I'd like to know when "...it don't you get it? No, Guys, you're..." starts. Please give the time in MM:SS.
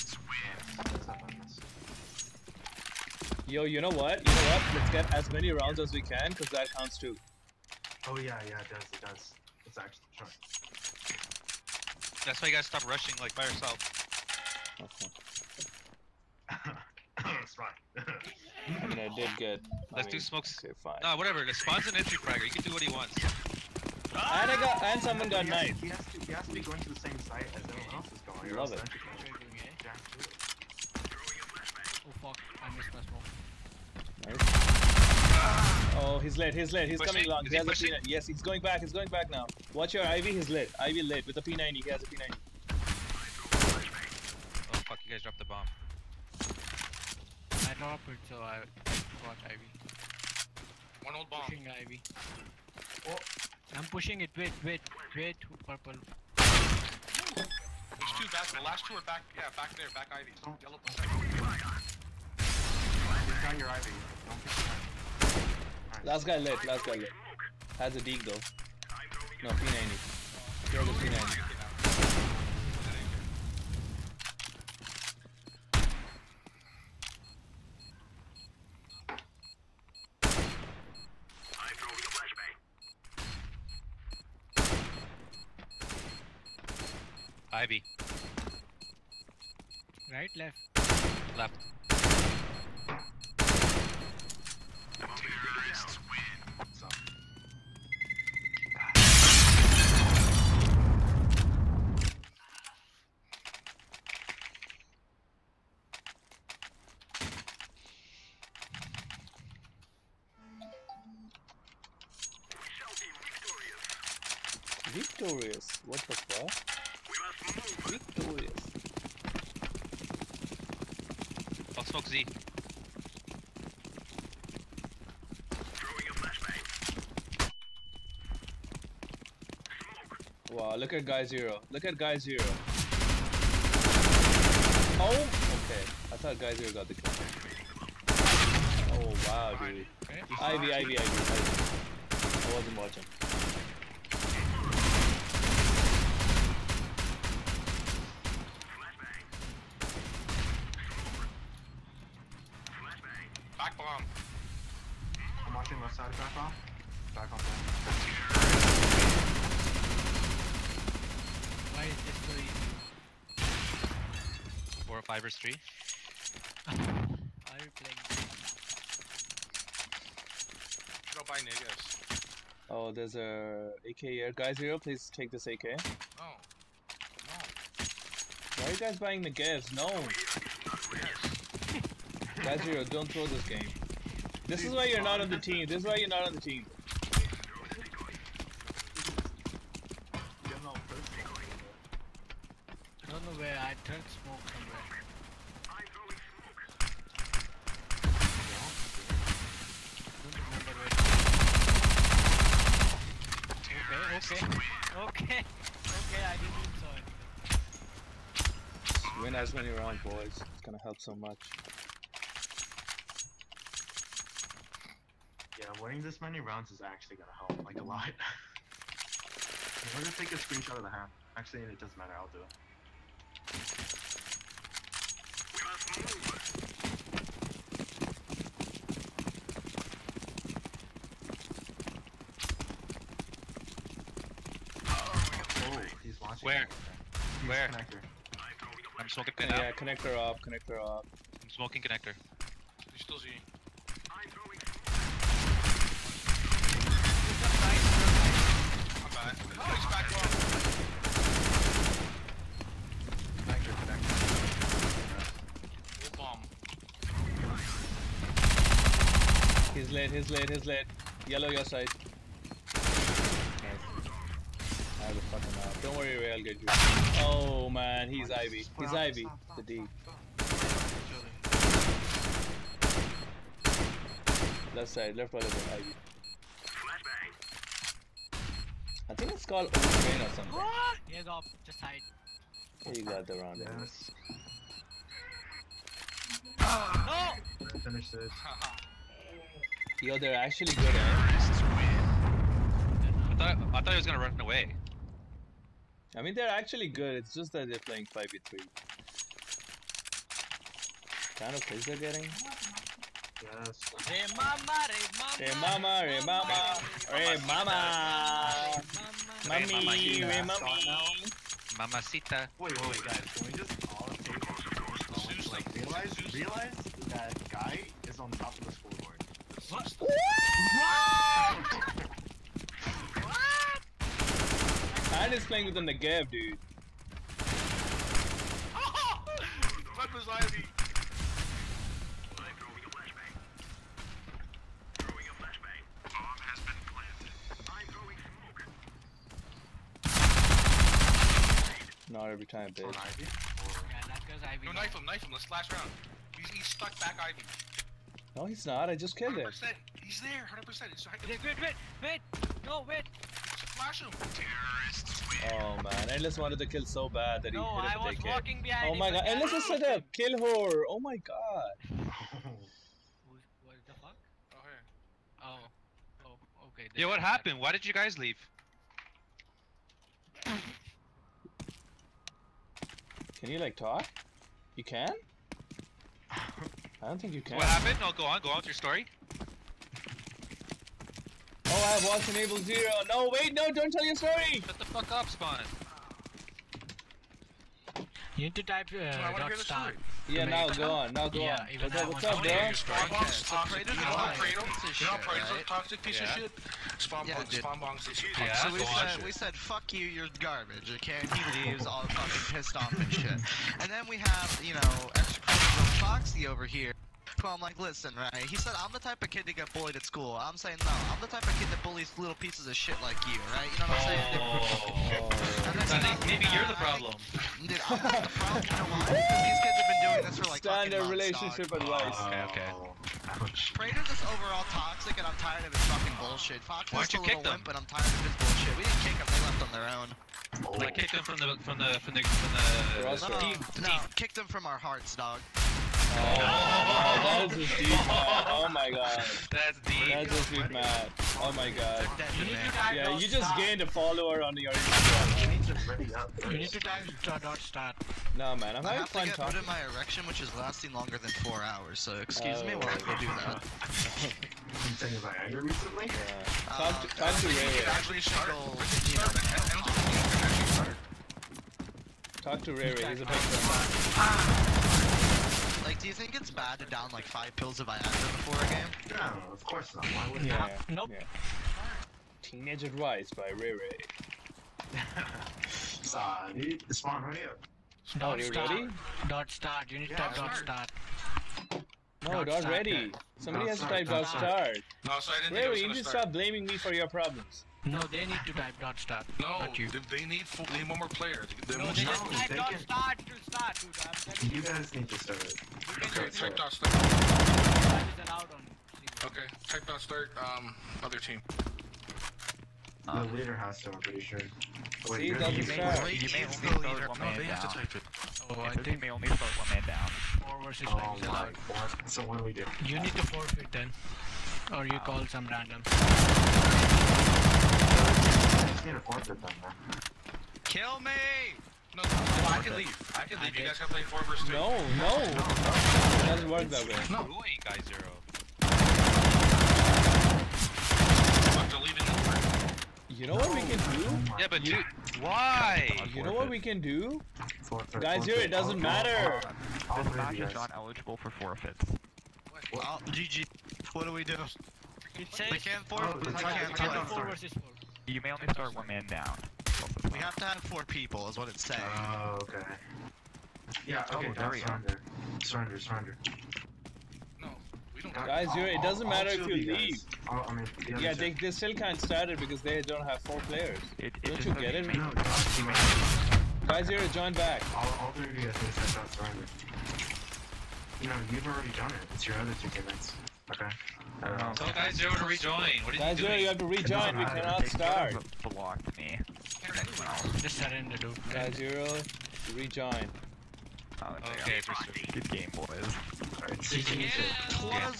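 09:24.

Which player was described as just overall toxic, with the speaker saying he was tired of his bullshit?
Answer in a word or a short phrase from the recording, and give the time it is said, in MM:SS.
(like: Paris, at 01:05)
Prater, at 07:03.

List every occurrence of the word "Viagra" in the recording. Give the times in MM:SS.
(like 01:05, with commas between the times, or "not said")
07:35, 07:47.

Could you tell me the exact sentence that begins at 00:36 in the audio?
Oh, he's late, he's late, he's pushing.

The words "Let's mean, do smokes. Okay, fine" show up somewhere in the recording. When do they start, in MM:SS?
00:19.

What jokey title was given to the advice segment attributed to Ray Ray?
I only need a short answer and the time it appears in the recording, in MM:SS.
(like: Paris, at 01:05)
Teenage Advice, at 07:52.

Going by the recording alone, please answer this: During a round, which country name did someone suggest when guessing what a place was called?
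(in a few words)
Ukraine.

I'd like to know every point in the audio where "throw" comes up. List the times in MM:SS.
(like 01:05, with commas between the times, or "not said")
03:03, 08:29.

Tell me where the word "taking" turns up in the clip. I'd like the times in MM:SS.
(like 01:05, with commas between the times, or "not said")
07:34.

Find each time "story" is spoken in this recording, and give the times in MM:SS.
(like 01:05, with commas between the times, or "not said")
06:18, 06:24.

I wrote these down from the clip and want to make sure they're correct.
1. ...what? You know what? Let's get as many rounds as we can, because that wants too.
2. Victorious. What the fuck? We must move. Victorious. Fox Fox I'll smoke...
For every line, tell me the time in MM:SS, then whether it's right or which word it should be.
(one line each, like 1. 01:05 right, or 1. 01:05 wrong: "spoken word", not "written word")
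1. 00:03 wrong: "counts", not "wants"
2. 01:55 right.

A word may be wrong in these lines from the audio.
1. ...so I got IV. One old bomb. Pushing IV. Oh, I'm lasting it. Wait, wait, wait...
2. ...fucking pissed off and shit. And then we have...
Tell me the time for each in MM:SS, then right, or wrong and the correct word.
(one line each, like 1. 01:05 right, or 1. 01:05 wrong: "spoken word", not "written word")
1. 00:48 wrong: "pushing", not "lasting"
2. 06:42 right.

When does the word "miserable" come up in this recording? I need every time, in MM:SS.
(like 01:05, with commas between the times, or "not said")
not said.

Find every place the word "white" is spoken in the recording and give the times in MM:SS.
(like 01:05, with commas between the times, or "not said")
not said.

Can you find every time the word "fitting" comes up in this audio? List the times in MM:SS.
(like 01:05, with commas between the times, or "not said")
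not said.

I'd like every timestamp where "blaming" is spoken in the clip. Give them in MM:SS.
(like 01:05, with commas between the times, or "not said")
08:06.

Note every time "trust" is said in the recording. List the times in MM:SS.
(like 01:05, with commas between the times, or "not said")
not said.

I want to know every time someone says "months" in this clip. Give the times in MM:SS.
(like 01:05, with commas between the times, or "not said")
07:01.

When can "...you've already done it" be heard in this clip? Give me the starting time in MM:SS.
09:31.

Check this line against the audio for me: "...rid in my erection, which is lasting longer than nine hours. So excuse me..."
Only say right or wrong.
wrong.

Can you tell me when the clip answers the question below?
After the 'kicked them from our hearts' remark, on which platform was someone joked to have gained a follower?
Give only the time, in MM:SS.
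07:24.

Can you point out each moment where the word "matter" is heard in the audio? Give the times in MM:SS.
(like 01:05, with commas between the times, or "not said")
03:41, 08:58, 09:19.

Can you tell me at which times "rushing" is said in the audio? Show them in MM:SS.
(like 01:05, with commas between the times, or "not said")
00:12.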